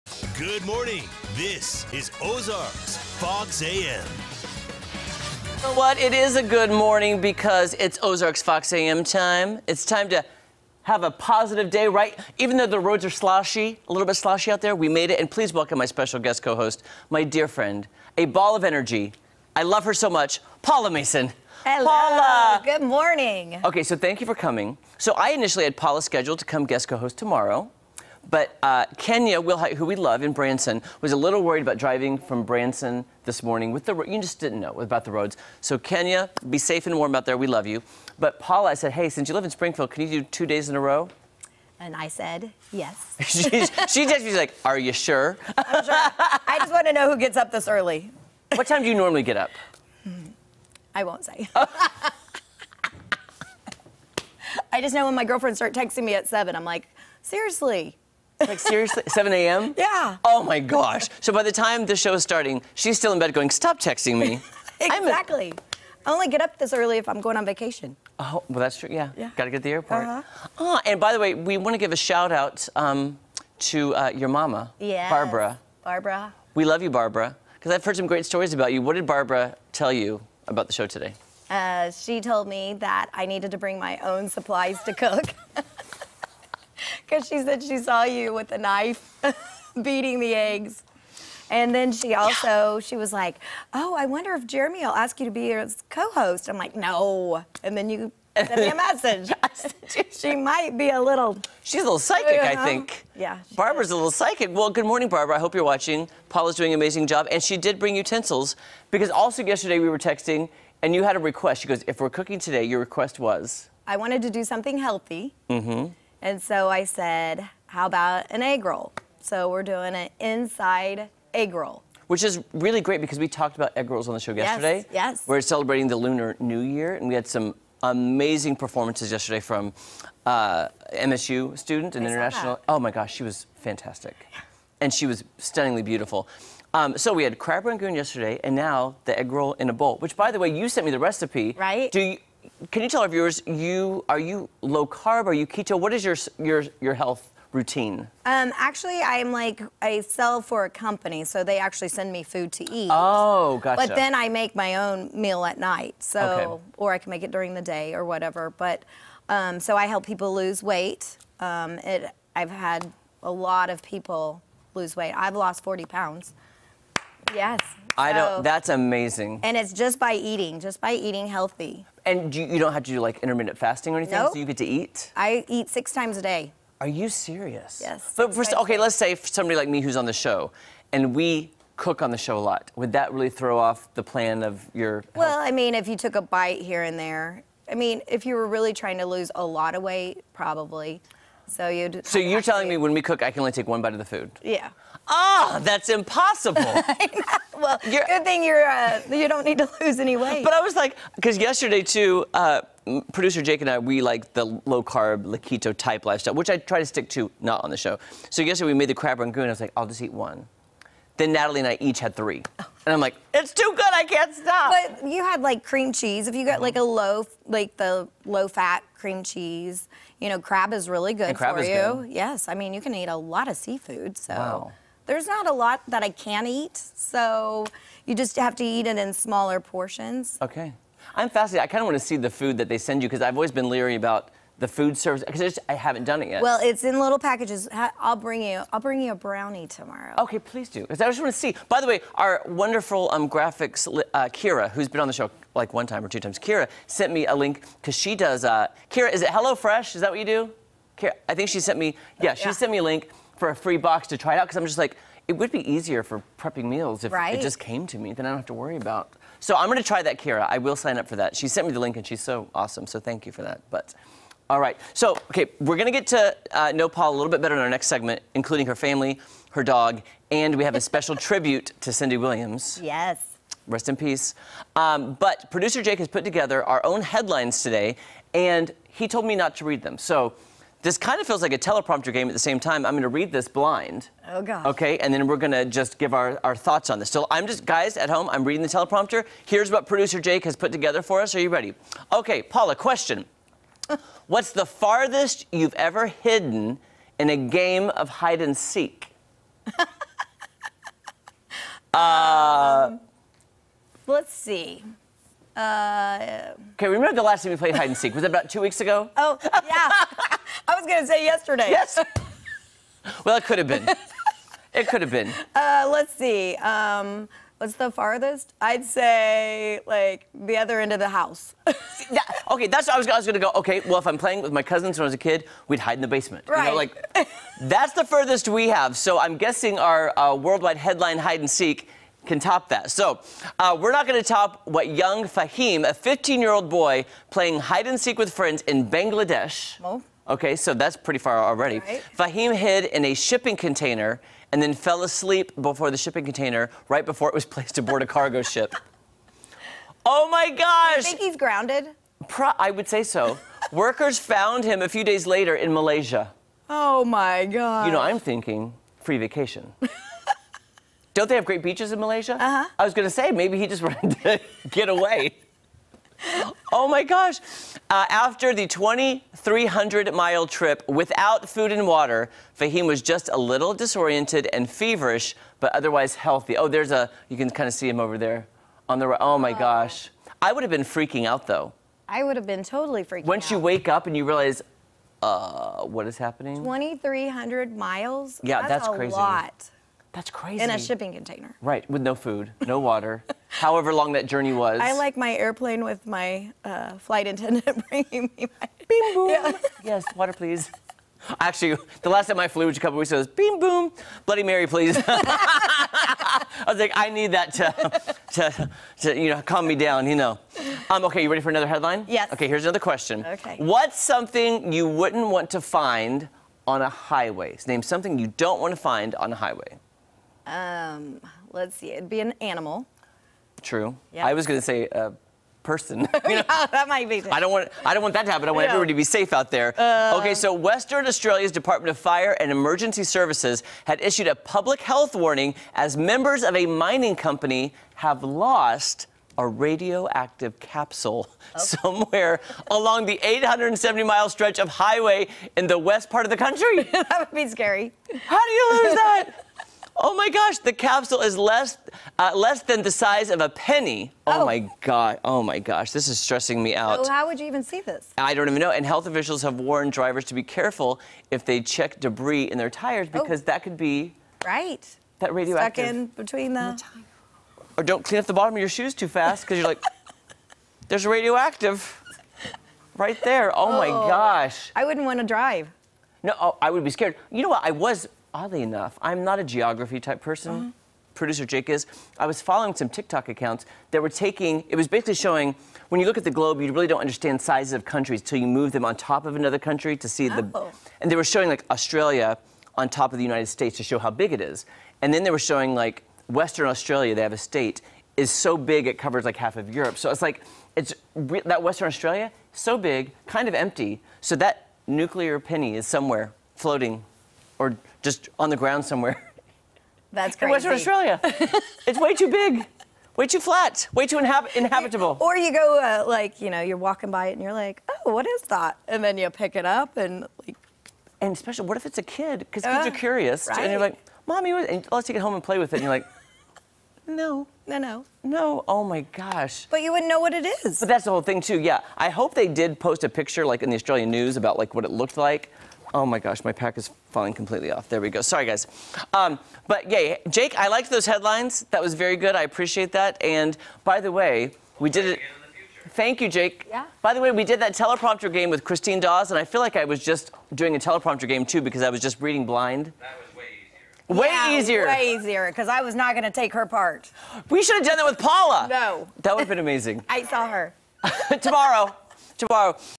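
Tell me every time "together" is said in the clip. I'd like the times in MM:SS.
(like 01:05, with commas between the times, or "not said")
04:36, 04:50.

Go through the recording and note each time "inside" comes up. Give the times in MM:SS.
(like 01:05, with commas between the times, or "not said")
02:00.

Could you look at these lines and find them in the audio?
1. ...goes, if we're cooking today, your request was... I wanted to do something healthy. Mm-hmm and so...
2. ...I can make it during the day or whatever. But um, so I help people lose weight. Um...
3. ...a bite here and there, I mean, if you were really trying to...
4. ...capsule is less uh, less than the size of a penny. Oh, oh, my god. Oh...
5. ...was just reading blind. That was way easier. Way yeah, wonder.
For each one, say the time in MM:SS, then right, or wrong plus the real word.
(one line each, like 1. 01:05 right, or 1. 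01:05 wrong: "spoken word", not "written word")
1. 01:51 right
2. 02:36 right
3. 03:06 right
4. 07:30 right
5. 09:11 wrong: "easier", not "wonder".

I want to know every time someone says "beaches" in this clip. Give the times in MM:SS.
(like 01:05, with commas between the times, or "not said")
06:01.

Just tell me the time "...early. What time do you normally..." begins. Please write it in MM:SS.
00:47.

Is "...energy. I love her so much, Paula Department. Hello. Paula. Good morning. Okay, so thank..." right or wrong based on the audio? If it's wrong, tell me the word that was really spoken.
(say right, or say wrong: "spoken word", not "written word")
wrong: "Mason", not "Department".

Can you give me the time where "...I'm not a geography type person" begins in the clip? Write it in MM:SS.
07:59.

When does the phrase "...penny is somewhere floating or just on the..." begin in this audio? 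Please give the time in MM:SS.
08:25.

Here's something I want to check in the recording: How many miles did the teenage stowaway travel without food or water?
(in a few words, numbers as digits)
2,300.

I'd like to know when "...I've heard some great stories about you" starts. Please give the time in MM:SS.
01:17.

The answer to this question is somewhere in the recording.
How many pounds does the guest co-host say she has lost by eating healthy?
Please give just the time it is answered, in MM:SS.
02:45.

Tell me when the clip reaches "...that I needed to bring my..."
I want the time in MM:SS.
01:22.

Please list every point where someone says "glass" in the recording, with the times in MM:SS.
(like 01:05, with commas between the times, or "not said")
not said.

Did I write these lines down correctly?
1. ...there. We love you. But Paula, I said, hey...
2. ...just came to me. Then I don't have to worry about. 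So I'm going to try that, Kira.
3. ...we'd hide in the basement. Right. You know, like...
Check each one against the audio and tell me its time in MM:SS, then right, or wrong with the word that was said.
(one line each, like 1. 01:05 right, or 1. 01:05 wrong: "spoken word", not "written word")
1. 00:37 right
2. 04:17 right
3. 05:25 right.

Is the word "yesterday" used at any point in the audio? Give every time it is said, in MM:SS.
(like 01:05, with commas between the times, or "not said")
01:49, 02:04, 02:09, 02:17, 03:21, 03:28, 05:11.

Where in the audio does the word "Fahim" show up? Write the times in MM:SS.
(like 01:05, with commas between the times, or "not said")
05:35, 05:42, 06:12.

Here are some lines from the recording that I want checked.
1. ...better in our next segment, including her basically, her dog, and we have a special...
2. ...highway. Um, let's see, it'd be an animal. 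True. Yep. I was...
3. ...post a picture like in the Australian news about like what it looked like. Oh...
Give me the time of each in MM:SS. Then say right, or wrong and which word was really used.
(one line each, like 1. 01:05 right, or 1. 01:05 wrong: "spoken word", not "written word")
1. 04:27 wrong: "family", not "basically"
2. 06:59 right
3. 08:52 right.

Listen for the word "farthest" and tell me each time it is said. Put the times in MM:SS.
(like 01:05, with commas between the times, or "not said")
04:54, 05:17.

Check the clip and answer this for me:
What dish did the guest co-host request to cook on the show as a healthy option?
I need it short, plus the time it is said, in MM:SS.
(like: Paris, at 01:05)
Egg roll in a bowl, at 02:19.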